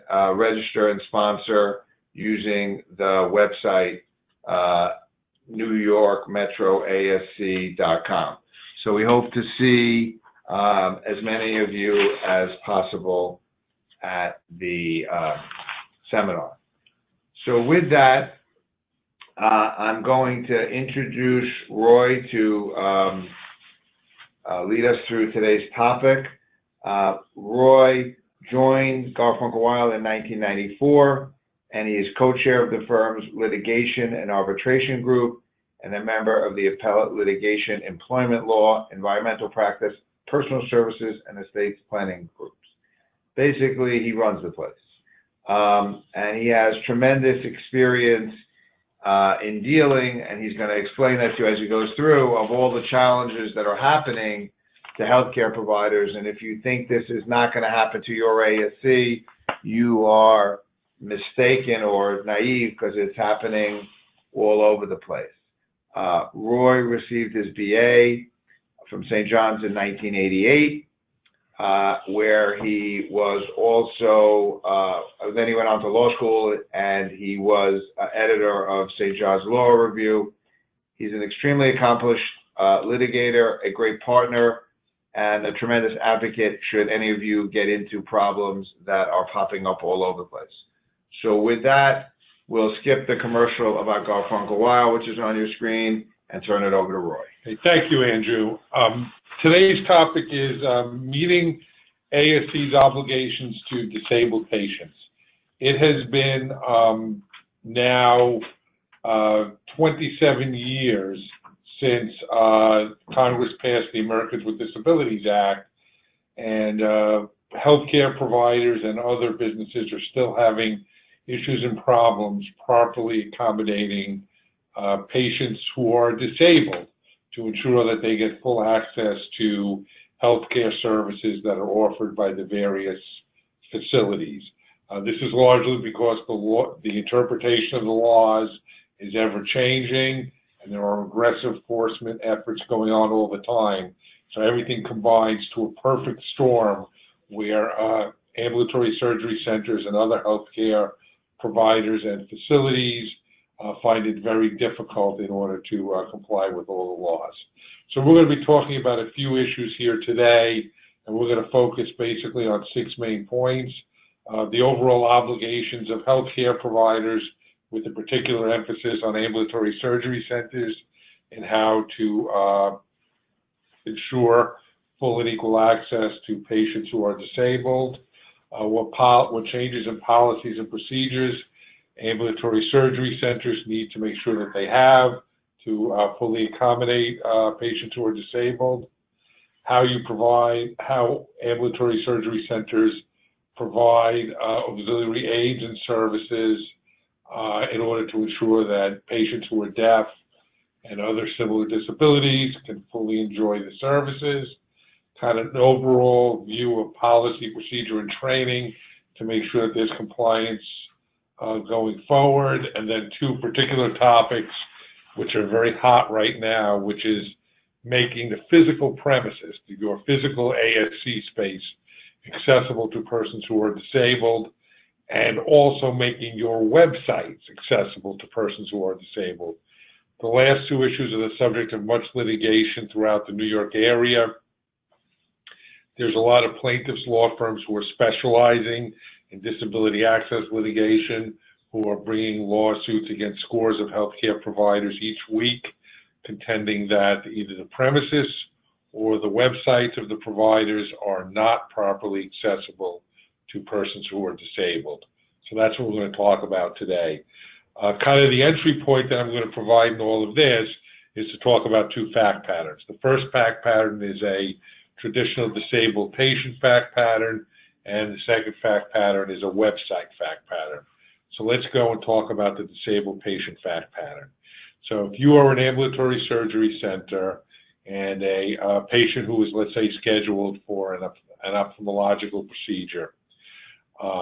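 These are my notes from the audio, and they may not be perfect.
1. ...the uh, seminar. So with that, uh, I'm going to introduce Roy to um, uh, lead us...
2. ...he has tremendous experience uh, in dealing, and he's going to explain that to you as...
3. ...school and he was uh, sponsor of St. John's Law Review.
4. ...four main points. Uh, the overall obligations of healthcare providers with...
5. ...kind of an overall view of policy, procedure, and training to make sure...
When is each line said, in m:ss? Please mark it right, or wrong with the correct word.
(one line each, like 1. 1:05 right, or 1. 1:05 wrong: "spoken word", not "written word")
1. 0:14 right
2. 0:46 right
3. 1:16 wrong: "editor", not "sponsor"
4. 2:42 wrong: "six", not "four"
5. 3:25 right.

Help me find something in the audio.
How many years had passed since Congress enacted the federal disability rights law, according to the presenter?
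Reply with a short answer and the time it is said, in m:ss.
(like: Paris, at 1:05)
27, at 1:49.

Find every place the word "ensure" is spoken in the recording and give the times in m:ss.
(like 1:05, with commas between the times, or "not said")
2:07, 2:53, 3:18.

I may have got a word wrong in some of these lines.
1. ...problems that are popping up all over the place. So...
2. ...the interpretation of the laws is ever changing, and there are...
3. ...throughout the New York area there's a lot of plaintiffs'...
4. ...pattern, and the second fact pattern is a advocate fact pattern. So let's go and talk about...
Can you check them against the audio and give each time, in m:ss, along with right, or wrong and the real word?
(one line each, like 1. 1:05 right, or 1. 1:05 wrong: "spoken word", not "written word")
1. 1:28 right
2. 2:16 right
3. 3:52 right
4. 4:26 wrong: "website", not "advocate".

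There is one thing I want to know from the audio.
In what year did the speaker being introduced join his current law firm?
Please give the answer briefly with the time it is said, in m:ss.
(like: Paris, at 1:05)
1994, at 0:30.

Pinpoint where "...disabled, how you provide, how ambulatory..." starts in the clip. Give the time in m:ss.
3:08.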